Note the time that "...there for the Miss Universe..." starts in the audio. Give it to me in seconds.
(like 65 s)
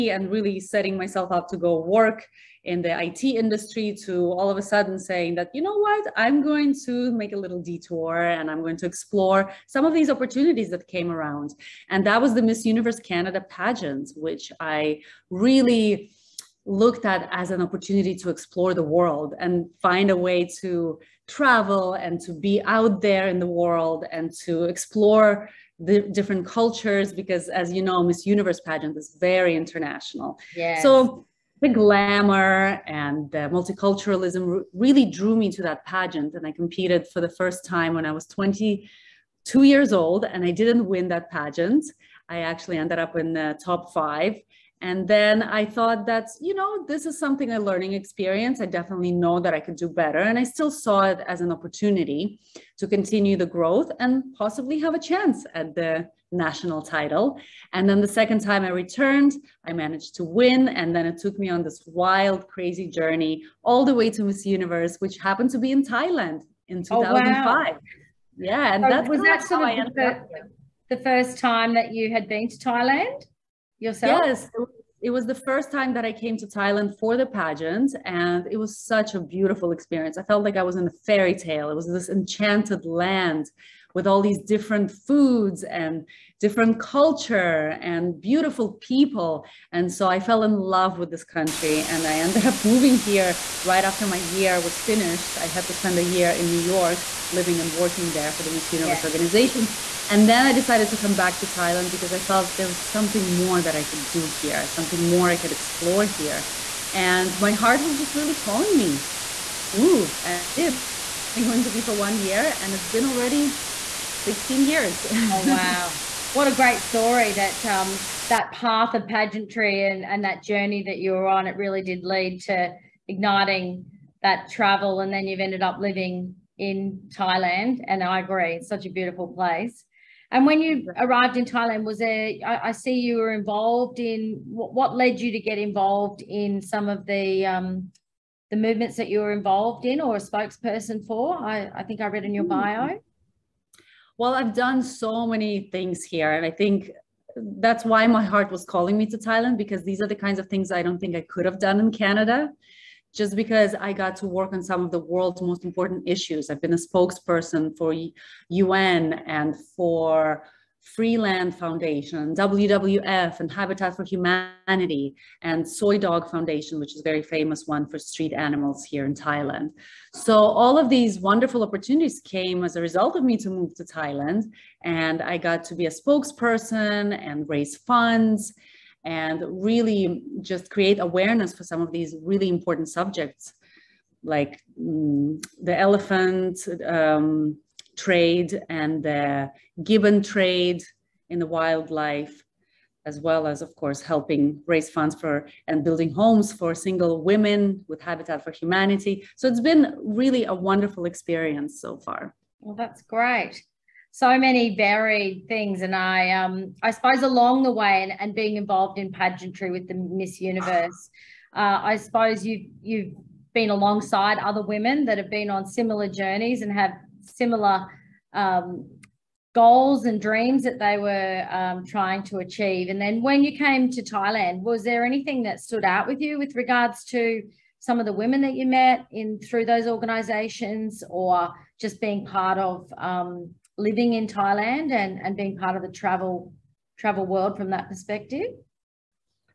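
98 s.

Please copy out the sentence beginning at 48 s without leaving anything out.
I definitely know that I could do better.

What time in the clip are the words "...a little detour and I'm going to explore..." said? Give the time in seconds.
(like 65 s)
7 s.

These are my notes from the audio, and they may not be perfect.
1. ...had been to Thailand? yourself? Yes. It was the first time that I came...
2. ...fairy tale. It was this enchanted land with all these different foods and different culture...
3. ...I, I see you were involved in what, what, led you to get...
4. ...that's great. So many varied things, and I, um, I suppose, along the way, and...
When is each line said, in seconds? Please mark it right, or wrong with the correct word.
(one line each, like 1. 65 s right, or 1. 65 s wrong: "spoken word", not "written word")
1. 72 s right
2. 81 s right
3. 132 s right
4. 202 s right.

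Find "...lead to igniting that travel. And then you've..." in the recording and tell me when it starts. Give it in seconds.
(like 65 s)
122 s.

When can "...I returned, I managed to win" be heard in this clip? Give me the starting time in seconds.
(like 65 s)
58 s.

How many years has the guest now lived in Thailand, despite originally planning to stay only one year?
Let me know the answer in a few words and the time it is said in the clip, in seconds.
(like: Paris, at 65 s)
16, at 114 s.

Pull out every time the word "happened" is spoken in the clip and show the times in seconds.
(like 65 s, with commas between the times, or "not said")
65 s.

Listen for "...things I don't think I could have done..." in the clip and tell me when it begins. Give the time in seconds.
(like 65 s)
150 s.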